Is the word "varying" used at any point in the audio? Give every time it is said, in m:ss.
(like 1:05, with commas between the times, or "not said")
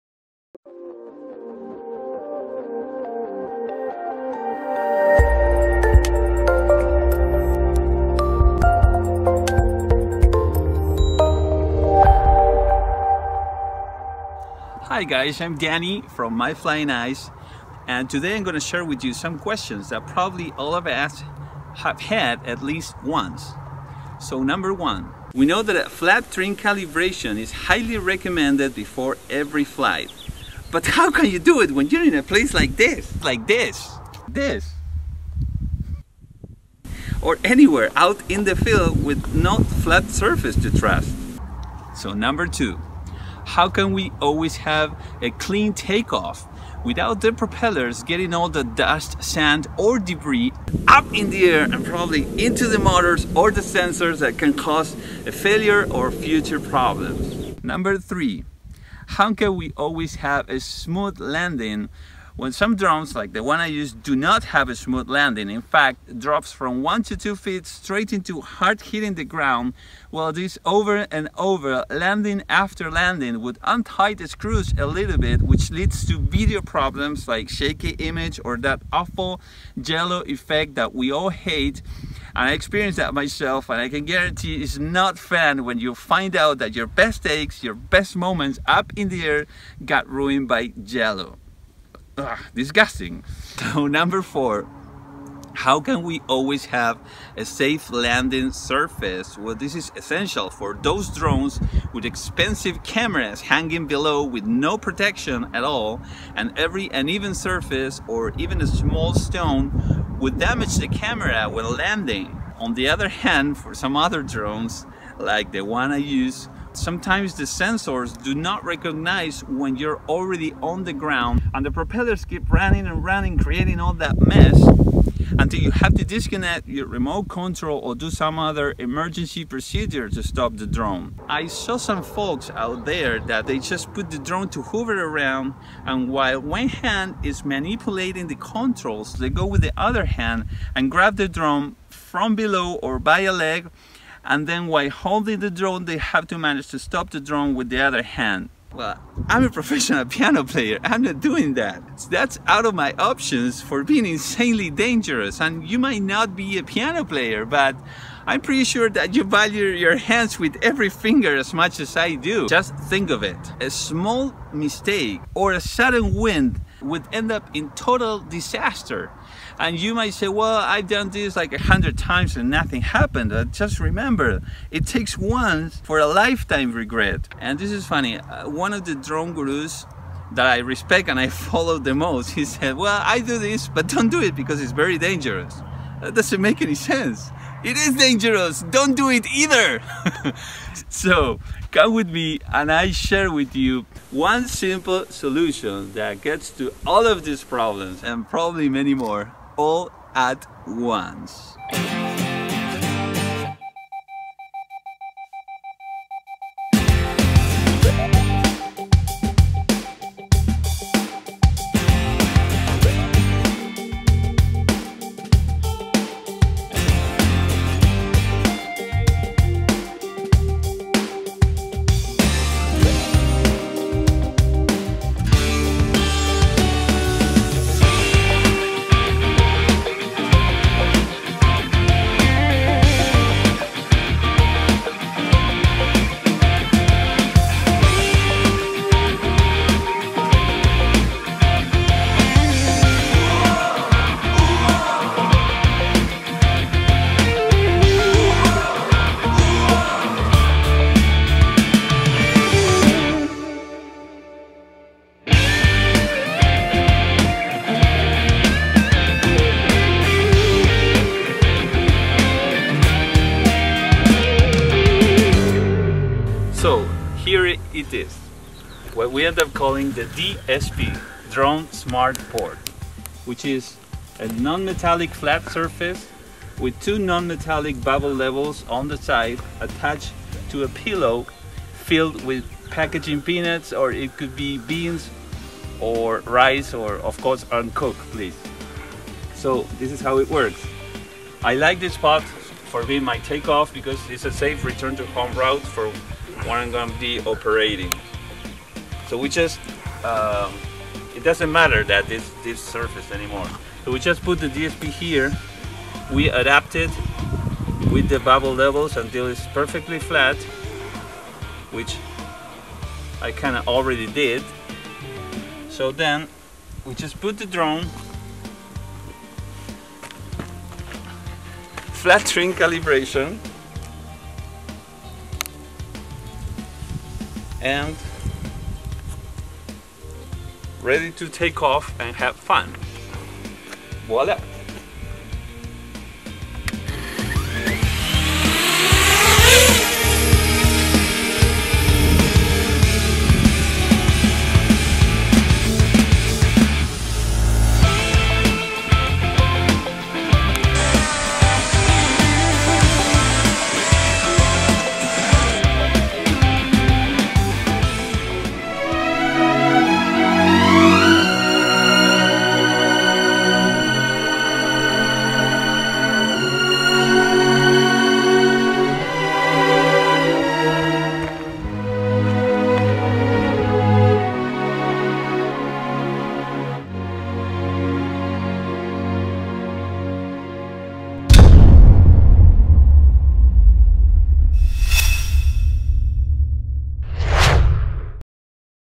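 not said.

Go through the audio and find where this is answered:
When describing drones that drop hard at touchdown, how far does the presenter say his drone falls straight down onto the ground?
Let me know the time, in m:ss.
1:06.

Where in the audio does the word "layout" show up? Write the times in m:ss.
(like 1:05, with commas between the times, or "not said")
not said.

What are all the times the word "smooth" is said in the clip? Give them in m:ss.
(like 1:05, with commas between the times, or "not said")
1:00, 1:04.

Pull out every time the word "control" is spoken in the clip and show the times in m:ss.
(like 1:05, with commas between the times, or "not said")
2:07, 2:18.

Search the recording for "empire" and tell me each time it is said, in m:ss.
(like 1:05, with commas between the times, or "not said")
not said.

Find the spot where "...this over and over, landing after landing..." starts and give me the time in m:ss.
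1:10.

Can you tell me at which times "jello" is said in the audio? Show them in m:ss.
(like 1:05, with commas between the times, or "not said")
1:19, 1:30.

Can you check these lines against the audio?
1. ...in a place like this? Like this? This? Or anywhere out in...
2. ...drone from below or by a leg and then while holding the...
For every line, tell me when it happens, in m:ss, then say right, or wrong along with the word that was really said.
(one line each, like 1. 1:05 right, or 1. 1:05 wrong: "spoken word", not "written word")
1. 0:32 right
2. 2:21 right.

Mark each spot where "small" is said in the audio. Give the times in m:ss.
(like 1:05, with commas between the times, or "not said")
1:48, 2:43.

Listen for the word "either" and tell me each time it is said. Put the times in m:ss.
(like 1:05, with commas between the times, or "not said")
3:09.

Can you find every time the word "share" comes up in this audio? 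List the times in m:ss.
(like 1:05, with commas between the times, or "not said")
0:18, 3:12.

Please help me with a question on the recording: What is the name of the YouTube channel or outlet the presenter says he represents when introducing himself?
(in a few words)
My Flying Eyes.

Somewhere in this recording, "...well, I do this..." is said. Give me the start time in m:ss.
3:02.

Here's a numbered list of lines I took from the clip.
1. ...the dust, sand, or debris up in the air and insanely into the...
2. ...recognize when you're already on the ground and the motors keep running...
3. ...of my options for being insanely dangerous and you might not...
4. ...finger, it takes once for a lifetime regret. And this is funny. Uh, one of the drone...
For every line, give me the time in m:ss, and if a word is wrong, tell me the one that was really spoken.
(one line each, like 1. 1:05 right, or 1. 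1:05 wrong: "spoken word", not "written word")
1. 0:48 wrong: "probably", not "insanely"
2. 1:58 wrong: "propellers", not "motors"
3. 2:32 right
4. 2:53 wrong: "remember", not "finger".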